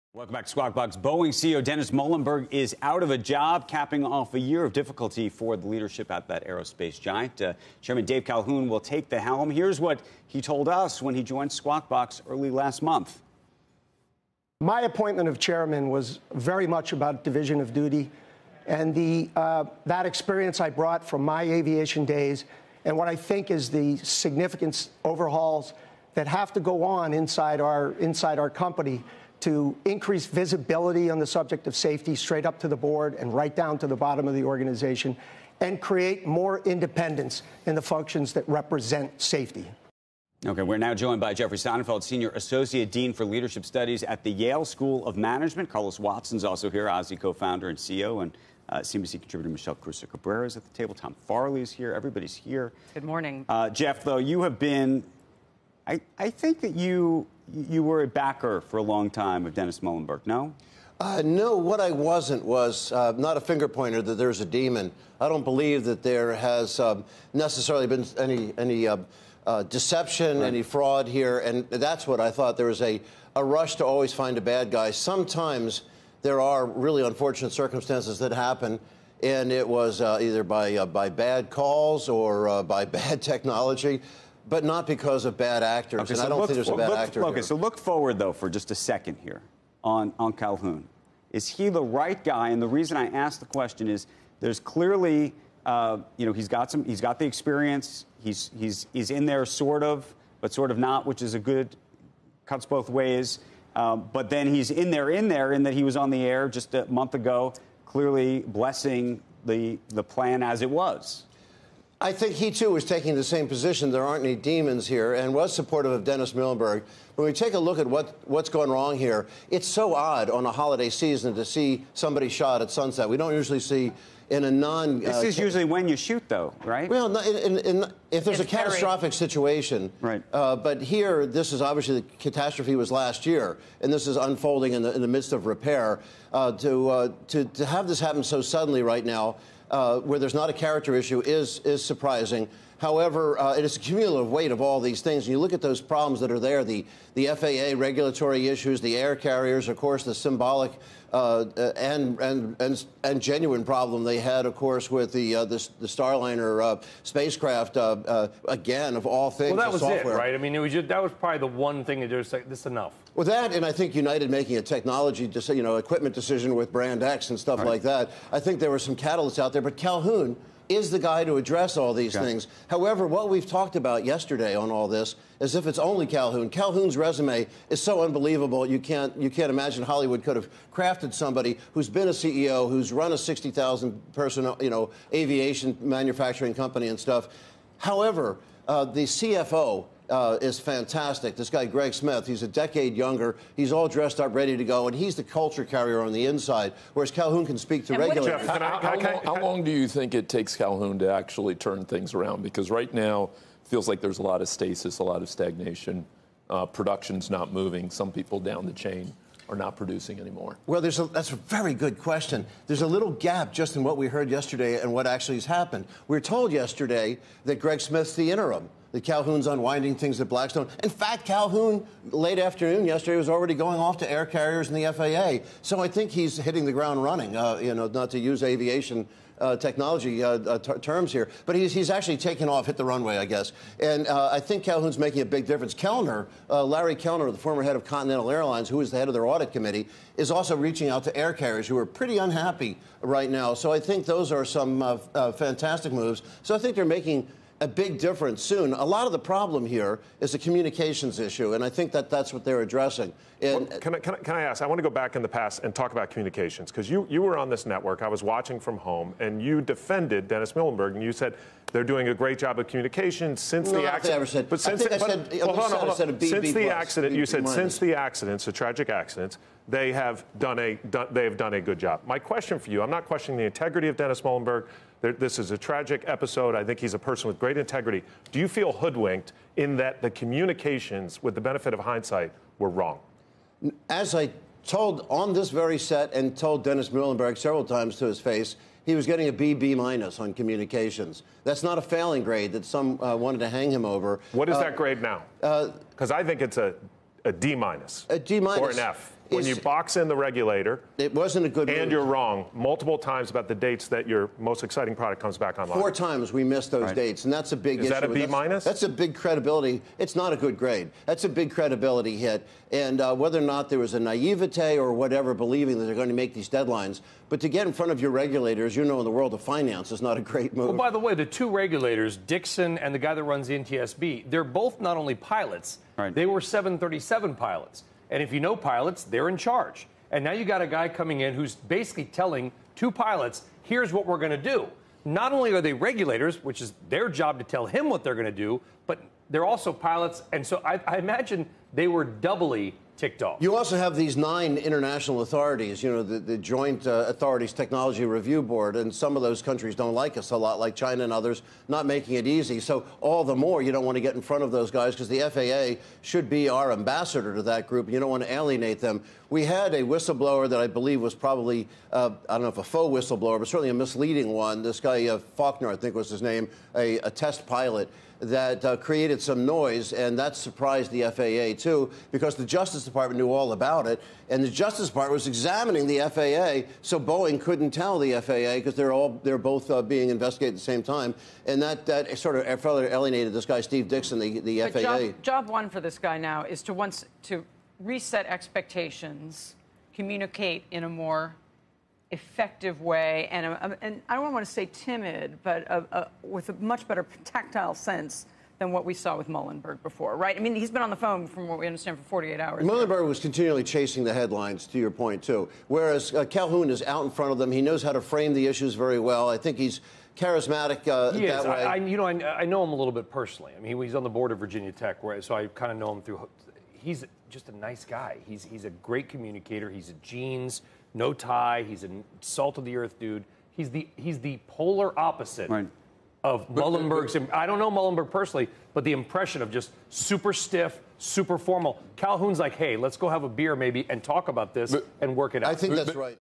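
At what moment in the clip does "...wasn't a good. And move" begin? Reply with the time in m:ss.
5:01.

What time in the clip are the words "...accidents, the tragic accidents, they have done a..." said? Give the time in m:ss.
4:27.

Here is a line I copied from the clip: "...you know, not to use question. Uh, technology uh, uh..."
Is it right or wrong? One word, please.
wrong.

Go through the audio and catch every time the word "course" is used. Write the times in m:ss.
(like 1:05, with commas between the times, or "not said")
2:29, 2:34.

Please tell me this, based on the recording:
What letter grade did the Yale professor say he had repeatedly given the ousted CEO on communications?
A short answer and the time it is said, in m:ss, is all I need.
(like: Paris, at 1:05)
B minus, at 4:49.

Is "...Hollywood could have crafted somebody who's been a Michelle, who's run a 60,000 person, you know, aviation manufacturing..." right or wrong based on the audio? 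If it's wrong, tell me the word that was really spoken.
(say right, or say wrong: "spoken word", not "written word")
wrong: "CEO", not "Michelle".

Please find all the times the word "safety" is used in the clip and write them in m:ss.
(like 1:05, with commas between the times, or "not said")
0:31, 0:39.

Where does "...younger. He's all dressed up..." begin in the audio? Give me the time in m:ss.
3:12.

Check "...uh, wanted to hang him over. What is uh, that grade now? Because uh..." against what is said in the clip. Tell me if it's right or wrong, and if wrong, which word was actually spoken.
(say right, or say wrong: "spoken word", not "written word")
right.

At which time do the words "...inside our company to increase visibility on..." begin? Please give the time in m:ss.
0:27.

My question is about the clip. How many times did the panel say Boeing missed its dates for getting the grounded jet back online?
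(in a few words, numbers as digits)
4.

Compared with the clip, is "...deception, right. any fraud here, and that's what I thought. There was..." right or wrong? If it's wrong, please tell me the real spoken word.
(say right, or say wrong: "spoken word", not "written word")
right.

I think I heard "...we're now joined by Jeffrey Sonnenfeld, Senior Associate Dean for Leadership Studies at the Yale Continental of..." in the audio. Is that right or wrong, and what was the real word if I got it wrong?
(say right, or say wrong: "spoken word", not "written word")
wrong: "School", not "Continental".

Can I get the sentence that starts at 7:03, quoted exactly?
He's the, he's the polar opposite right of uh, Muilenburg's.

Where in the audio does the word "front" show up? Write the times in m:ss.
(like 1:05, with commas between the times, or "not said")
5:17, 5:54, 6:47.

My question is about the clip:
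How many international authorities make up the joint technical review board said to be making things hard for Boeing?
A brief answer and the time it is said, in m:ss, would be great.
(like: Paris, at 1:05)
9, at 5:44.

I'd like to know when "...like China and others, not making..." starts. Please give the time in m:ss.
5:50.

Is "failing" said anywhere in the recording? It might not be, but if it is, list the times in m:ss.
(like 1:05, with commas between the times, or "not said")
4:51.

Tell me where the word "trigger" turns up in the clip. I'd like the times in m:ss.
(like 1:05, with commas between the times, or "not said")
not said.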